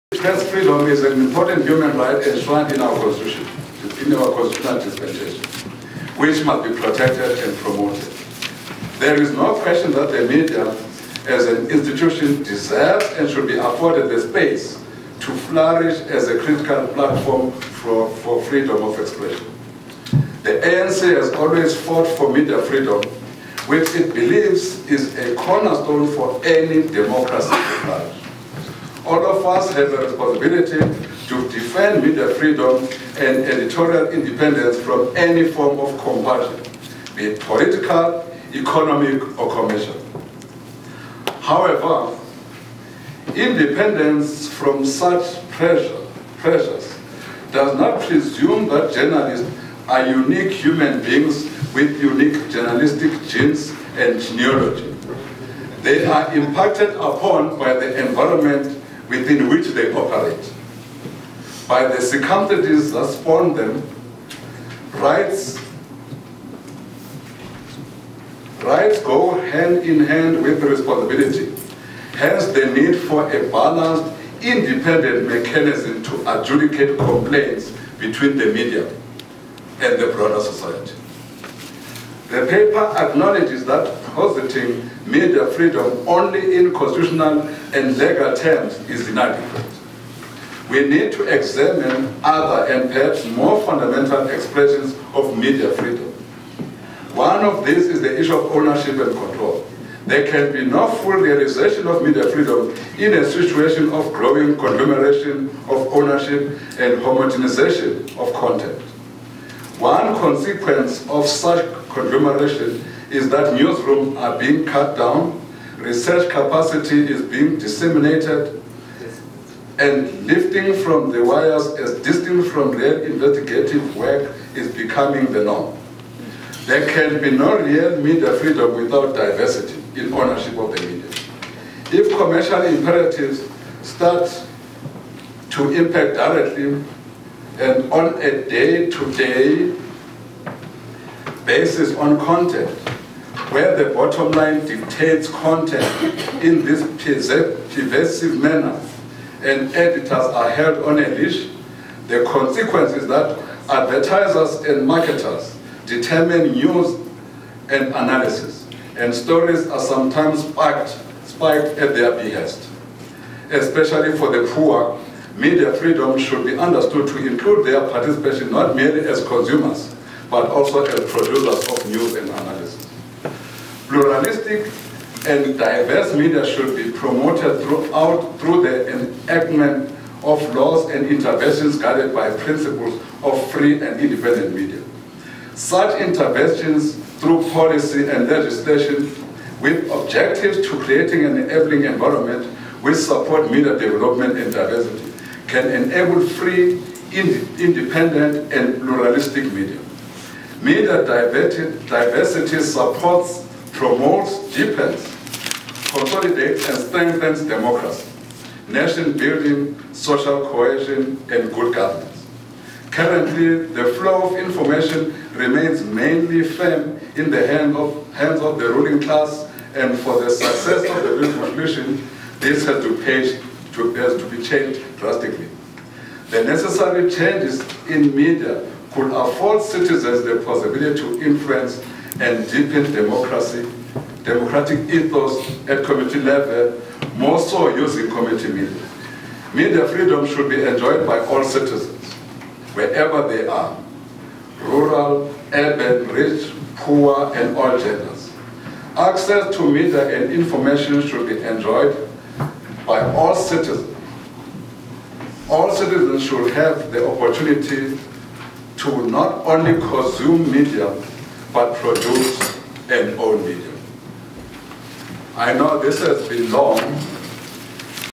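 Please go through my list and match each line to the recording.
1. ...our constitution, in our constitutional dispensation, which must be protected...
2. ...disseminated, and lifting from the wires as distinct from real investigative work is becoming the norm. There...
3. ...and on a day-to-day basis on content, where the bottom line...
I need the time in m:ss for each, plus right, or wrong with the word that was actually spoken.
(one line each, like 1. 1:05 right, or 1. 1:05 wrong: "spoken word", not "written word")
1. 0:02 right
2. 1:57 right
3. 2:17 right.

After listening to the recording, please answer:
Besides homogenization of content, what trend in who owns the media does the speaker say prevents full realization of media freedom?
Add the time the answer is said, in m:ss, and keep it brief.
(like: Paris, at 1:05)
conglomeration of ownership, at 1:44.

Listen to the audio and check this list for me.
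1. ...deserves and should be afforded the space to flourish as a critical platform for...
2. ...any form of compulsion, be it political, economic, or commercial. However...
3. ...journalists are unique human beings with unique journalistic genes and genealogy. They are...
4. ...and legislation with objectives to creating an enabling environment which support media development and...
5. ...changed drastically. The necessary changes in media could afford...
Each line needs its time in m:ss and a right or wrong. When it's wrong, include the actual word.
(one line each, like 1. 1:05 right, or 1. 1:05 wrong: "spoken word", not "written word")
1. 0:12 right
2. 0:35 right
3. 0:48 right
4. 3:08 right
5. 3:44 right.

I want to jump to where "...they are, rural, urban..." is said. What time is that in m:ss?
4:03.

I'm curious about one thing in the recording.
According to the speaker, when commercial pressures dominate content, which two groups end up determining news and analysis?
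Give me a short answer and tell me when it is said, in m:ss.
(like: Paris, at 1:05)
advertisers and marketers, at 2:33.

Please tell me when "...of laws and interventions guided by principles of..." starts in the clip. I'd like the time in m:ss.
3:00.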